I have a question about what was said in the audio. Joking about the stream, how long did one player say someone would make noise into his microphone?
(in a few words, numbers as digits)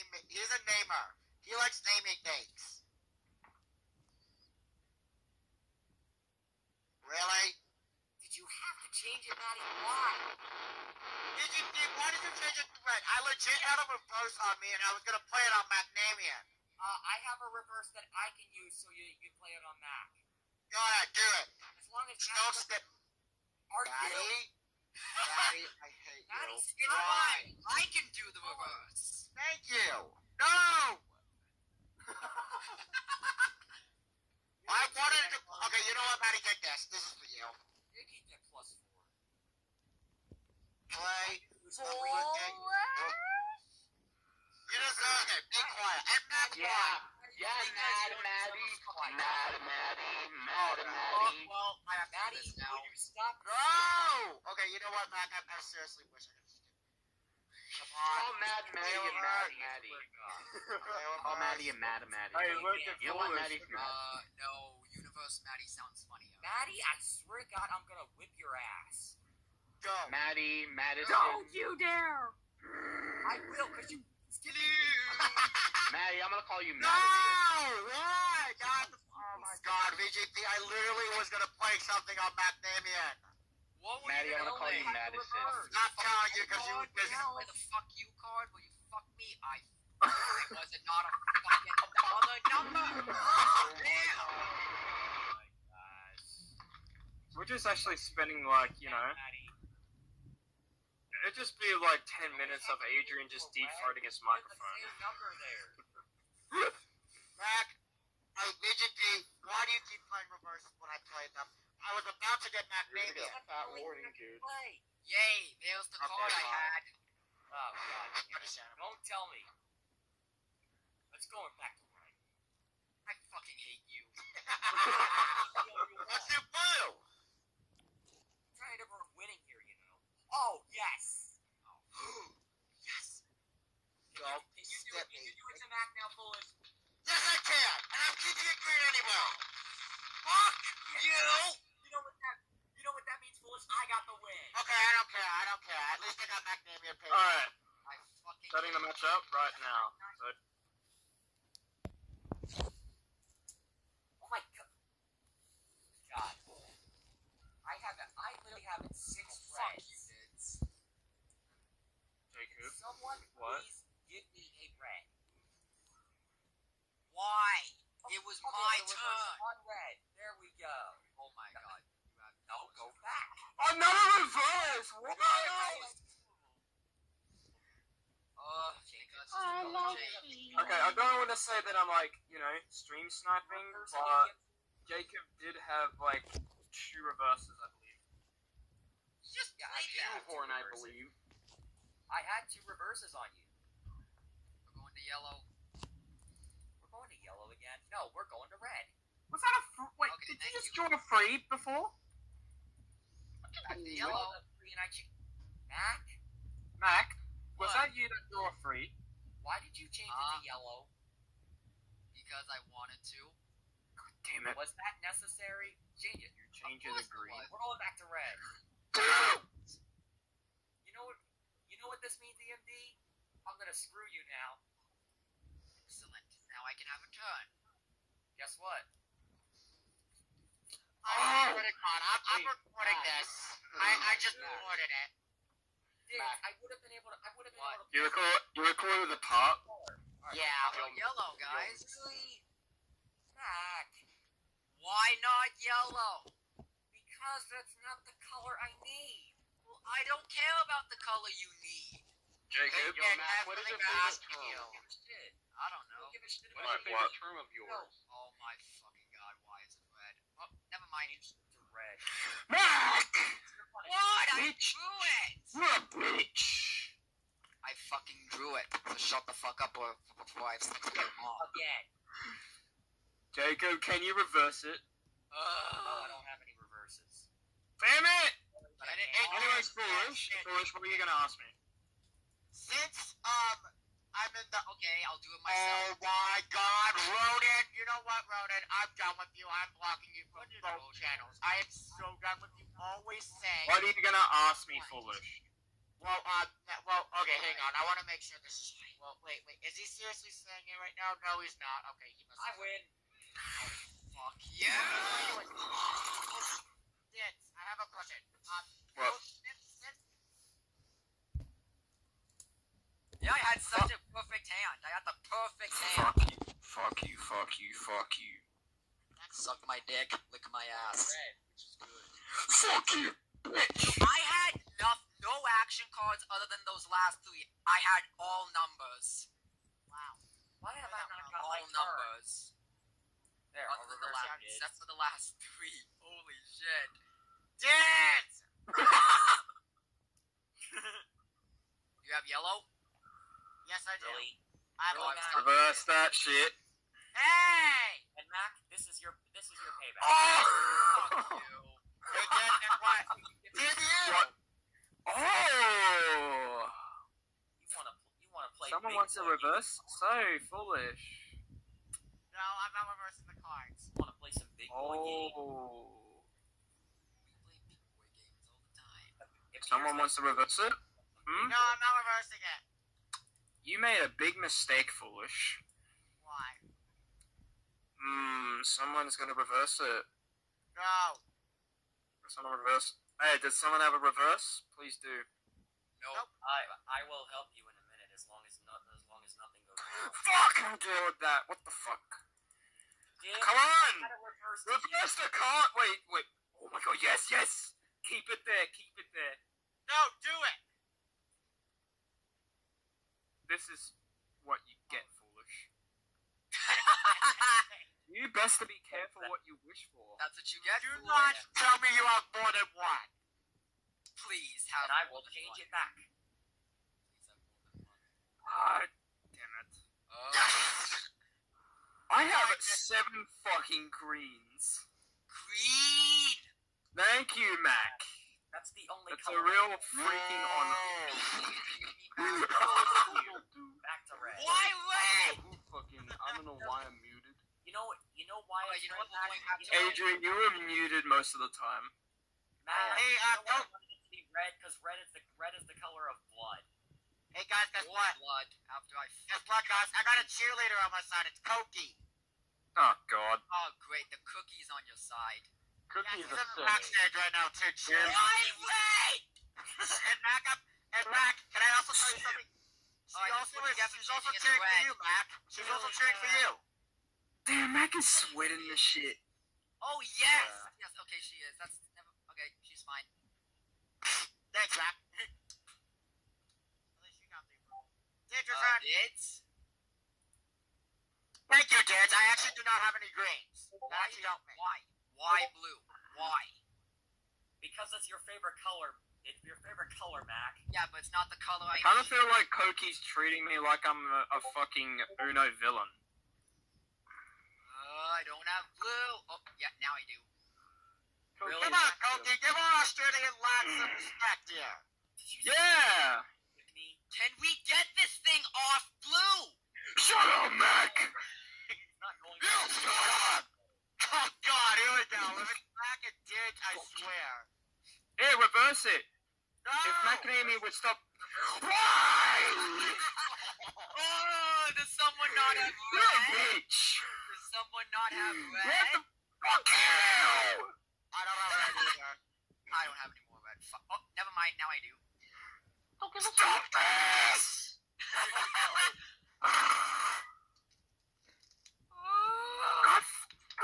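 10 minutes.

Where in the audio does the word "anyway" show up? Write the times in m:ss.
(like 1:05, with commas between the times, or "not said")
2:18, 4:39.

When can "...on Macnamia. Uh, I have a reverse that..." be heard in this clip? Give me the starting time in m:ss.
0:15.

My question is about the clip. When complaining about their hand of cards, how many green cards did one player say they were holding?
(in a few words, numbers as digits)
7.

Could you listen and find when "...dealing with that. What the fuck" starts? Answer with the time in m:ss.
6:30.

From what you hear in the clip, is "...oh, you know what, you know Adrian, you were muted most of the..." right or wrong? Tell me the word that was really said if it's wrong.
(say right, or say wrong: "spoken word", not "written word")
right.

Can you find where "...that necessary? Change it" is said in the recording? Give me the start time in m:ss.
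3:34.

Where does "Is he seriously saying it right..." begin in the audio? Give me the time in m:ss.
4:59.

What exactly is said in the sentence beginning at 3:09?
You just yeah, played I that.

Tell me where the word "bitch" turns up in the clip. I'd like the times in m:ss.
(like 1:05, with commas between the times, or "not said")
4:25, 5:23, 8:46.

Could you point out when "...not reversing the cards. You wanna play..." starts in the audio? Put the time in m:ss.
6:02.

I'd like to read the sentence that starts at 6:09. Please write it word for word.
If Someone wants to reverse it.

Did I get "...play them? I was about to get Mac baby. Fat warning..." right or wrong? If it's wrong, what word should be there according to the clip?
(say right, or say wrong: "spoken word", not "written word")
right.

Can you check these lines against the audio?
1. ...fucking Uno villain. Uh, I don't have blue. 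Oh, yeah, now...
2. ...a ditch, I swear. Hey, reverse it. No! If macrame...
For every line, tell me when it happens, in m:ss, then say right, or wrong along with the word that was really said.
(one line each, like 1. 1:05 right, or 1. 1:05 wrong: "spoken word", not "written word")
1. 8:14 right
2. 8:36 right.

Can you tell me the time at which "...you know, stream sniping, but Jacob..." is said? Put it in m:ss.
3:02.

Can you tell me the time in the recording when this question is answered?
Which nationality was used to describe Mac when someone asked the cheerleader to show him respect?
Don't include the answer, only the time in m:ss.
8:22.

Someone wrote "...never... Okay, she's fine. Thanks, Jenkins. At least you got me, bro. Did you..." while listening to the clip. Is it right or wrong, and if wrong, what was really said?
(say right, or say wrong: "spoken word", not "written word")
wrong: "Mac", not "Jenkins".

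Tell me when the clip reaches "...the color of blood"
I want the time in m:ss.
7:25.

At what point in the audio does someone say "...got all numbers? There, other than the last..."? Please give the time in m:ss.
5:31.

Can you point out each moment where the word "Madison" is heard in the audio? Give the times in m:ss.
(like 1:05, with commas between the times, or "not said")
1:10, 1:24.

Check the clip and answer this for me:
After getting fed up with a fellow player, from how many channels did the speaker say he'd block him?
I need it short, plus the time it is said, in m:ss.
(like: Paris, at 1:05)
Both, at 4:50.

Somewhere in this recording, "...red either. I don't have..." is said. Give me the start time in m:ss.
8:51.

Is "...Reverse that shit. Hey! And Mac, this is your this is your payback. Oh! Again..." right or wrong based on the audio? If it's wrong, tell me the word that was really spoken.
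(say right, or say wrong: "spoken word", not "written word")
right.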